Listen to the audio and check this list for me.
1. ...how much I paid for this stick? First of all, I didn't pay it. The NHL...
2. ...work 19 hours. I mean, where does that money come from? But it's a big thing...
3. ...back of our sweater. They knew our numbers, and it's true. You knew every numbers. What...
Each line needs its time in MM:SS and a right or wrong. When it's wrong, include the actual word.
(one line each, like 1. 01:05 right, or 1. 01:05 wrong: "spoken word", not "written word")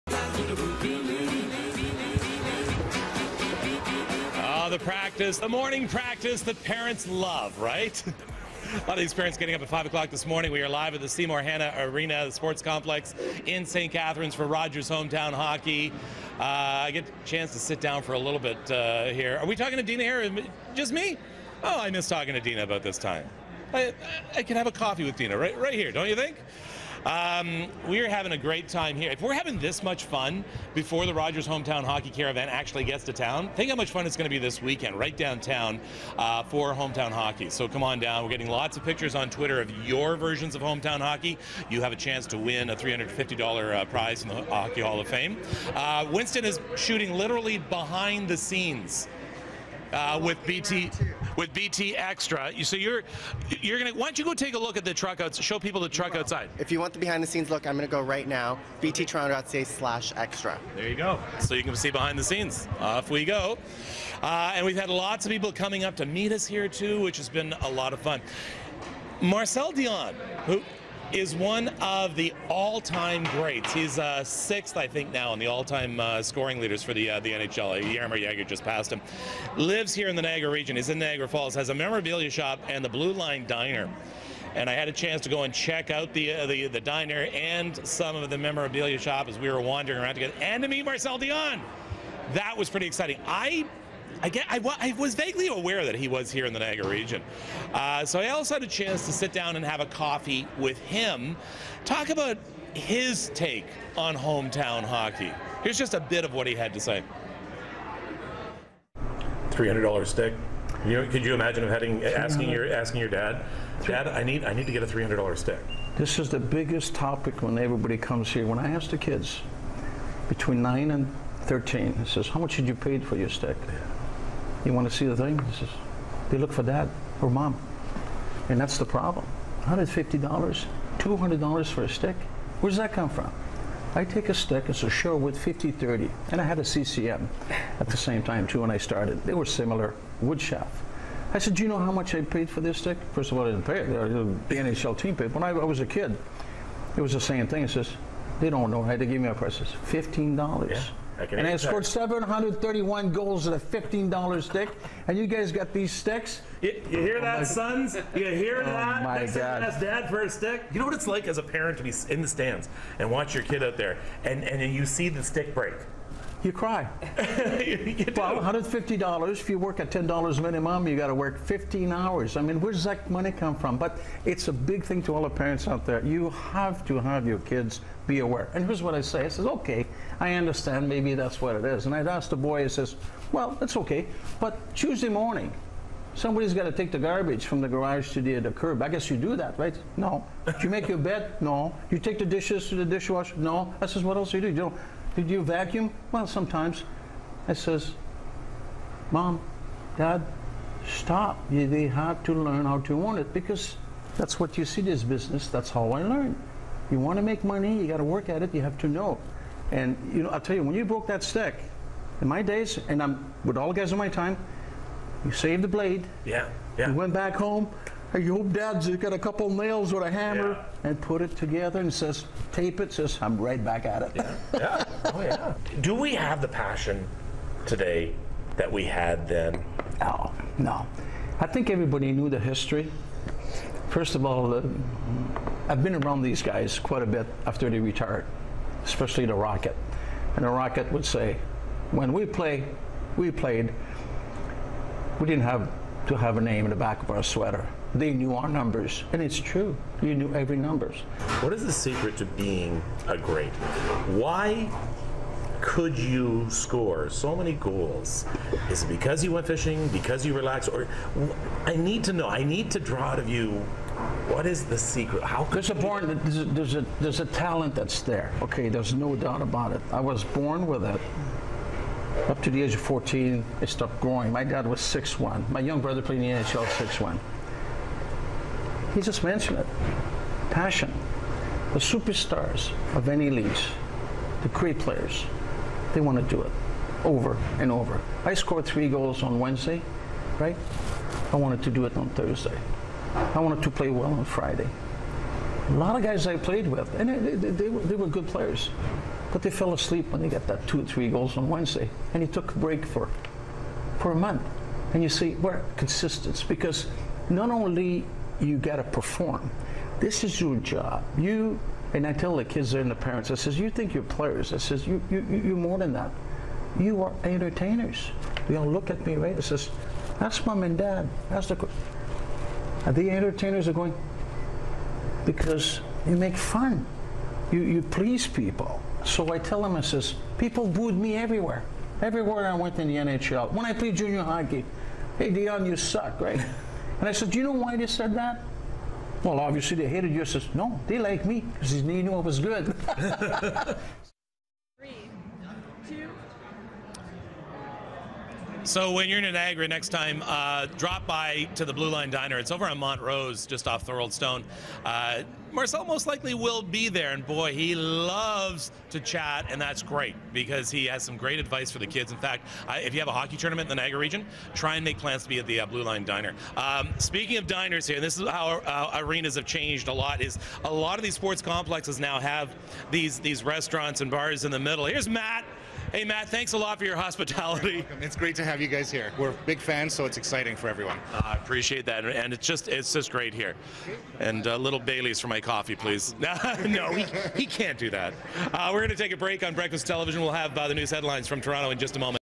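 1. 02:21 right
2. 02:51 wrong: "15", not "19"
3. 04:06 right.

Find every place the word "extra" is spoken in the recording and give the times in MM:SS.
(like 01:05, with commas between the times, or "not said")
00:51, 00:58.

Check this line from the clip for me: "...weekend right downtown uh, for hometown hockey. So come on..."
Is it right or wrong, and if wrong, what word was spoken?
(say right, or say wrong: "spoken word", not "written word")
right.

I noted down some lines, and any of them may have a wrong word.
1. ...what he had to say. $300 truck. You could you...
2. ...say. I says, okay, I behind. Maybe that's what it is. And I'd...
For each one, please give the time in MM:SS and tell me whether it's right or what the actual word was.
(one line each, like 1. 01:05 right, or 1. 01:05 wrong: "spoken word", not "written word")
1. 01:46 wrong: "stick", not "truck"
2. 02:59 wrong: "understand", not "behind".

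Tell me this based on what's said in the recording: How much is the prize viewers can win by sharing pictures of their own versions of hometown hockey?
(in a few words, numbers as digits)
$350.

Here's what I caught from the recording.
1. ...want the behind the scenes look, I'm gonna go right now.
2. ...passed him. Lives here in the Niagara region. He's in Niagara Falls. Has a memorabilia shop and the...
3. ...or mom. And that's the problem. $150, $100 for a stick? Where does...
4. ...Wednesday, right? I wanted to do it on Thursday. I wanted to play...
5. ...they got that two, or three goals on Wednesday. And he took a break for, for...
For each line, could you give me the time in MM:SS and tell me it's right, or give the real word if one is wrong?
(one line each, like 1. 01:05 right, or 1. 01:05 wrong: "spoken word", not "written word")
1. 00:56 right
2. 01:18 right
3. 02:07 wrong: "200", not "100"
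4. 04:49 right
5. 05:00 right.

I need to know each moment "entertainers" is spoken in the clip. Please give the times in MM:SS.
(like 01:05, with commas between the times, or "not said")
05:17, 05:23.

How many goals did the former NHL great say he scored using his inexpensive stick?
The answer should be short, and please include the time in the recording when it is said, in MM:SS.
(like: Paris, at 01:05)
731, at 02:31.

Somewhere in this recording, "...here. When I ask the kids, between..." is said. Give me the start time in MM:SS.
01:58.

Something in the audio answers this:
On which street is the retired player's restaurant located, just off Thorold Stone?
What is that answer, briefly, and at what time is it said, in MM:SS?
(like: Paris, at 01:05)
Montrose, at 05:52.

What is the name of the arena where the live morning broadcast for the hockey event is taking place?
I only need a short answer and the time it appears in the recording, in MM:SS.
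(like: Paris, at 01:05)
Seymour Hannah Arena, at 00:11.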